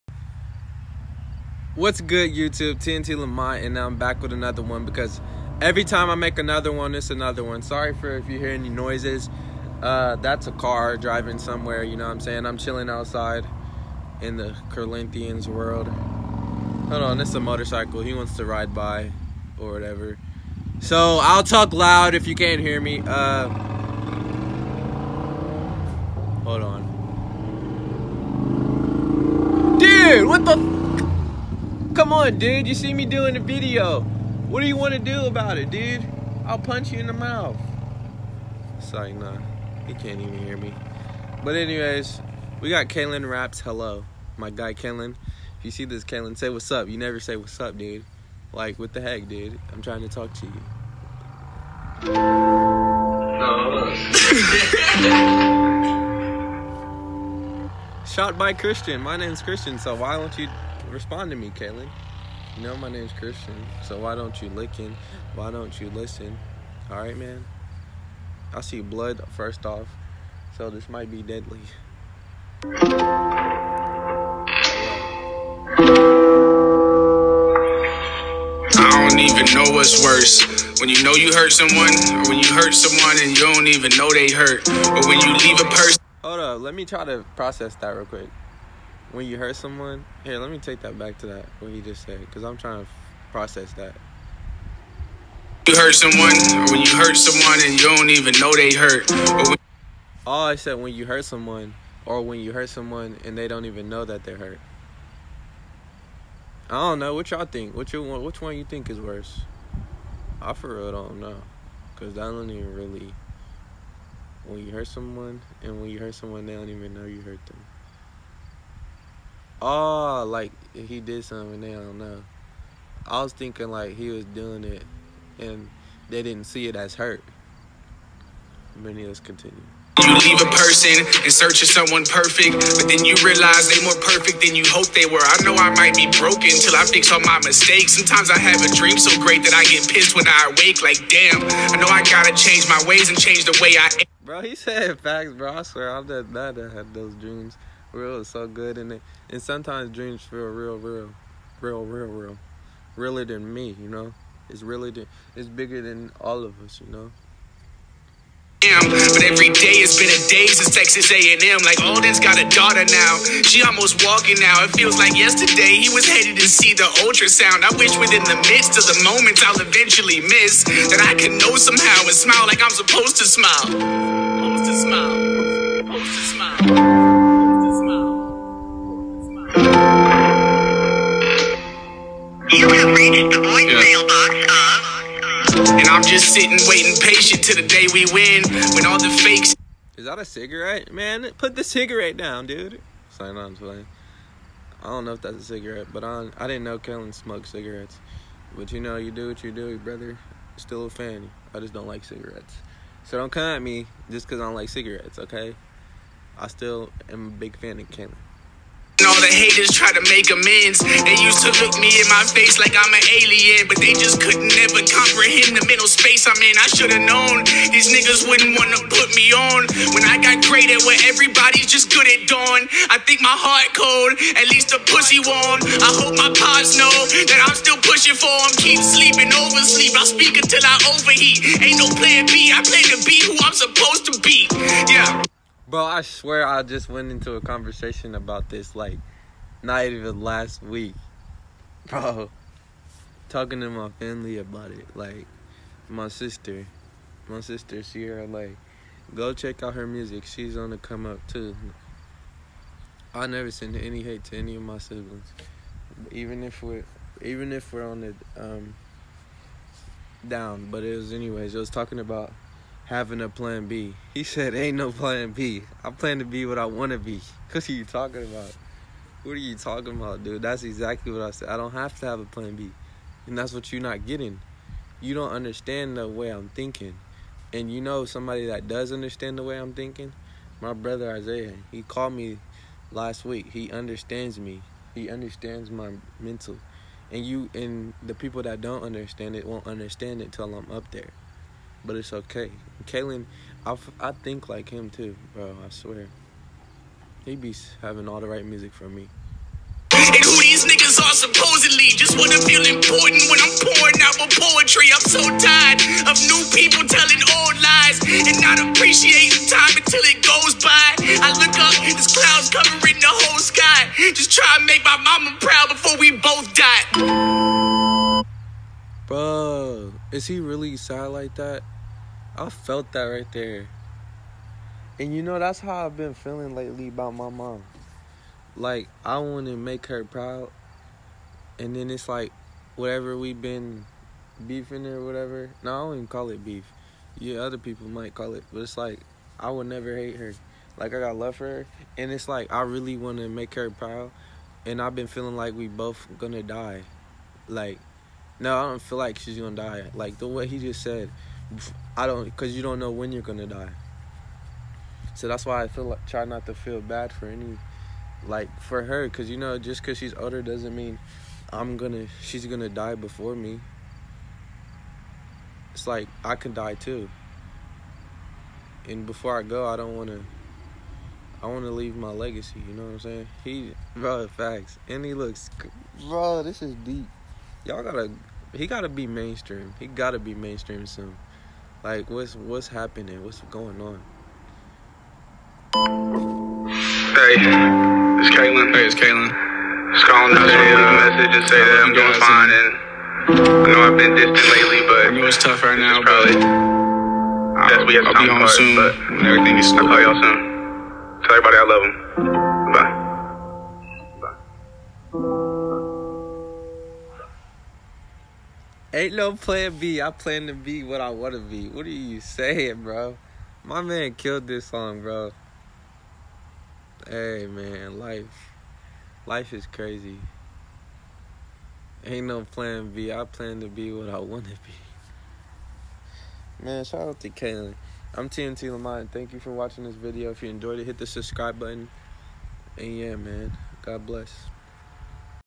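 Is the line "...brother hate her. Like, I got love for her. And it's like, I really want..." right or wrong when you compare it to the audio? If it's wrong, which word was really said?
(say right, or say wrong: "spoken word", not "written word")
wrong: "never", not "brother".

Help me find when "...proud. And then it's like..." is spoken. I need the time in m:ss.
5:30.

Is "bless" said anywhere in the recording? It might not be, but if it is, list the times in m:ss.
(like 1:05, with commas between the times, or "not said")
7:14.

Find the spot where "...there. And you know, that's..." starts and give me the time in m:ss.
5:23.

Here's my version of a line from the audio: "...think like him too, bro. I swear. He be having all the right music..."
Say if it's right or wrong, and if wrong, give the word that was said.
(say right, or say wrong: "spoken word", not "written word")
right.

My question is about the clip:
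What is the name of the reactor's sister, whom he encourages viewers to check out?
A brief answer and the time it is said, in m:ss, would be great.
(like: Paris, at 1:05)
Sierra, at 4:07.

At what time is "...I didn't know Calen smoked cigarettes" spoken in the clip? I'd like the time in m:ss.
3:16.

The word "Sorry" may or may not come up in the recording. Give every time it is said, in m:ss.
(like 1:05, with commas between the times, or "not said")
0:07, 0:38.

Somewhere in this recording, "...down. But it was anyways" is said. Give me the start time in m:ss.
4:20.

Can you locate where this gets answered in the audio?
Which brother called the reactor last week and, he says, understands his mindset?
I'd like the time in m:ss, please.
4:40.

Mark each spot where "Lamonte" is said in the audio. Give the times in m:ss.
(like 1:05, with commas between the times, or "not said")
0:03, 7:08.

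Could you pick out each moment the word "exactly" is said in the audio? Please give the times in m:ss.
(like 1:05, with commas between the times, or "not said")
4:30.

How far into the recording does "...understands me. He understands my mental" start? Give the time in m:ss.
4:43.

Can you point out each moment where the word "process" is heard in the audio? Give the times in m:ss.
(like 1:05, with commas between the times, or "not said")
1:27, 1:33.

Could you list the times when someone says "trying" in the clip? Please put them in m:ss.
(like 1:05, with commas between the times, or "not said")
0:49, 1:32.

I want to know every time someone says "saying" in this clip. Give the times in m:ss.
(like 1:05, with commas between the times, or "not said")
0:12, 6:12, 6:52.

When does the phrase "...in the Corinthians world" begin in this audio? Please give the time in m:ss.
0:14.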